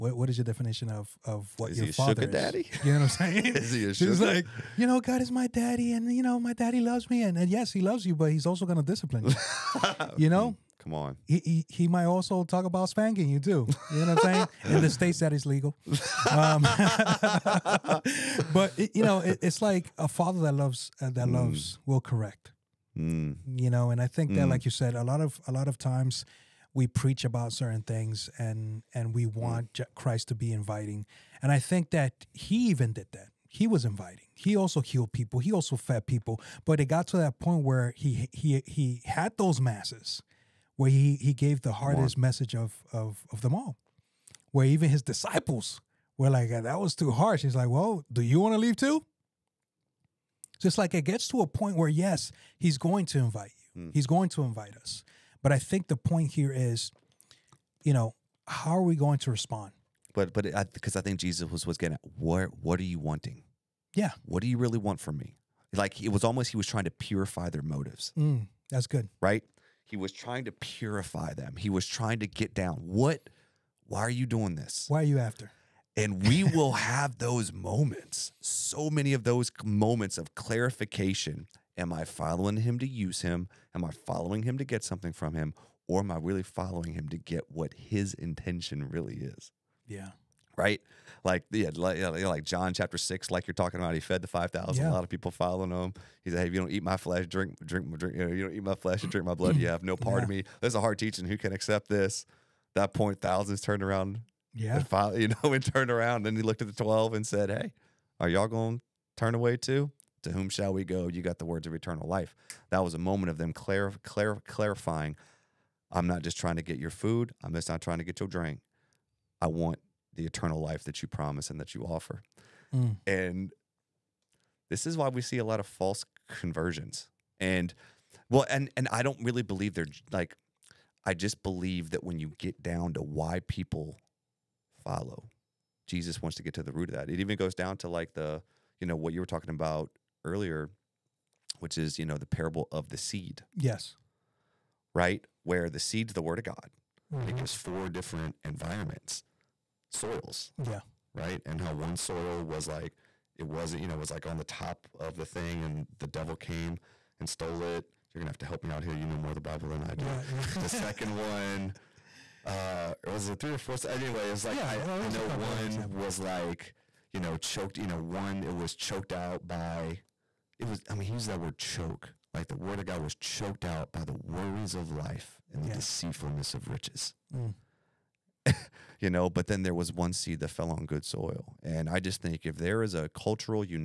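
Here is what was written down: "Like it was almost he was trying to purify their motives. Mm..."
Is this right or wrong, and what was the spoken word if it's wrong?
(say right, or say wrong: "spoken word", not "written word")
right.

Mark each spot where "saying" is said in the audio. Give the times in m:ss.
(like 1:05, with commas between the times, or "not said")
0:03, 0:14.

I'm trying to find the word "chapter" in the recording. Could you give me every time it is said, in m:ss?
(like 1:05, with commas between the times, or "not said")
1:32.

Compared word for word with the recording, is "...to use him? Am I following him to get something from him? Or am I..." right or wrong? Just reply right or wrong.
right.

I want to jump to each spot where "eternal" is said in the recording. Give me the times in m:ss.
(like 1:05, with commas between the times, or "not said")
1:51, 2:00.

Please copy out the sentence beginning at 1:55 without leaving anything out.
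I'm not just trying to get your food.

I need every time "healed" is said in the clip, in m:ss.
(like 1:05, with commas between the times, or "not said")
0:34.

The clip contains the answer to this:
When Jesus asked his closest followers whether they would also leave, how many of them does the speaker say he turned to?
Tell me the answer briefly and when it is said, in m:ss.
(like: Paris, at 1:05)
12, at 1:46.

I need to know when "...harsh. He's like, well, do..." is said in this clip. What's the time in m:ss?
0:47.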